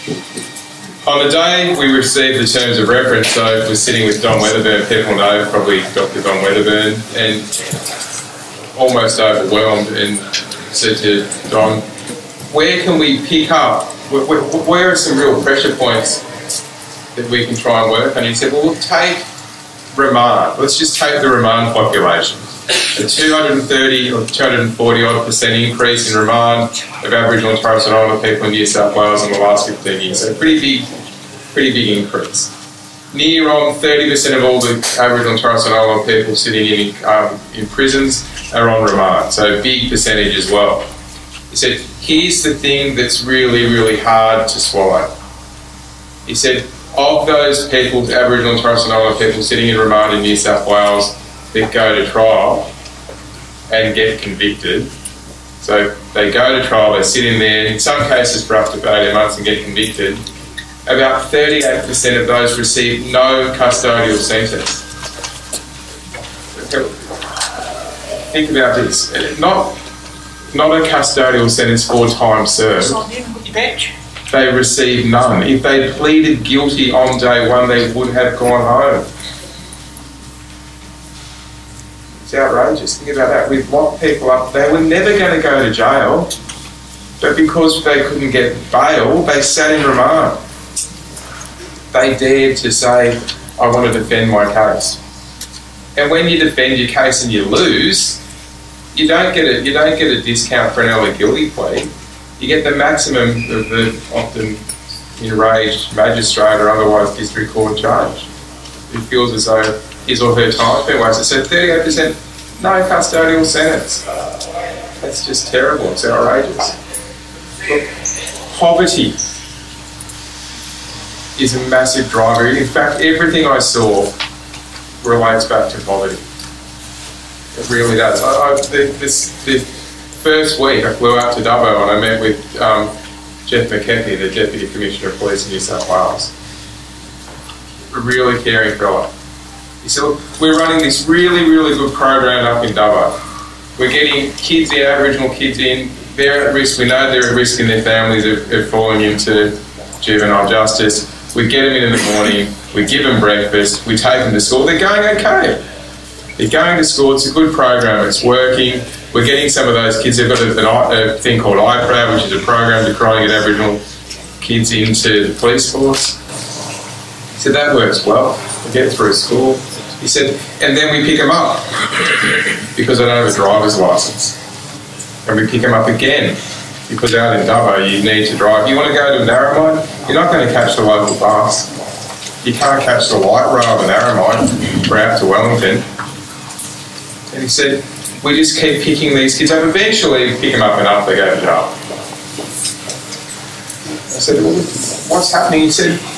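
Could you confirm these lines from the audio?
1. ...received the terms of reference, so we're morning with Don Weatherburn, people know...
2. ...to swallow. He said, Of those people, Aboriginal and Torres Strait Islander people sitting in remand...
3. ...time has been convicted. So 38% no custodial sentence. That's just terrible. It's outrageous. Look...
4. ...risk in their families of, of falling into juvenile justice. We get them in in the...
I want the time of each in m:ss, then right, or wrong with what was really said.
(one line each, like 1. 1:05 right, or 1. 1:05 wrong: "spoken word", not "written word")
1. 0:01 wrong: "sitting", not "morning"
2. 0:44 right
3. 1:50 wrong: "wasted", not "convicted"
4. 2:27 right.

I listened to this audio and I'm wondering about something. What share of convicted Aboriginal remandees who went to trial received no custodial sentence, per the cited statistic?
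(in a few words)
38%.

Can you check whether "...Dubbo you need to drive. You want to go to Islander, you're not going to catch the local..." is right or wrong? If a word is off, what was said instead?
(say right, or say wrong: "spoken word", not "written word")
wrong: "Narromine", not "Islander".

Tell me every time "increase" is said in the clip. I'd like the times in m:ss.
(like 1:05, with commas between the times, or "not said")
0:25, 0:32.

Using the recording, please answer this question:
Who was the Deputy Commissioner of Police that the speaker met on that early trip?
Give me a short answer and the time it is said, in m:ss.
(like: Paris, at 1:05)
Jeff McKechnie, at 2:13.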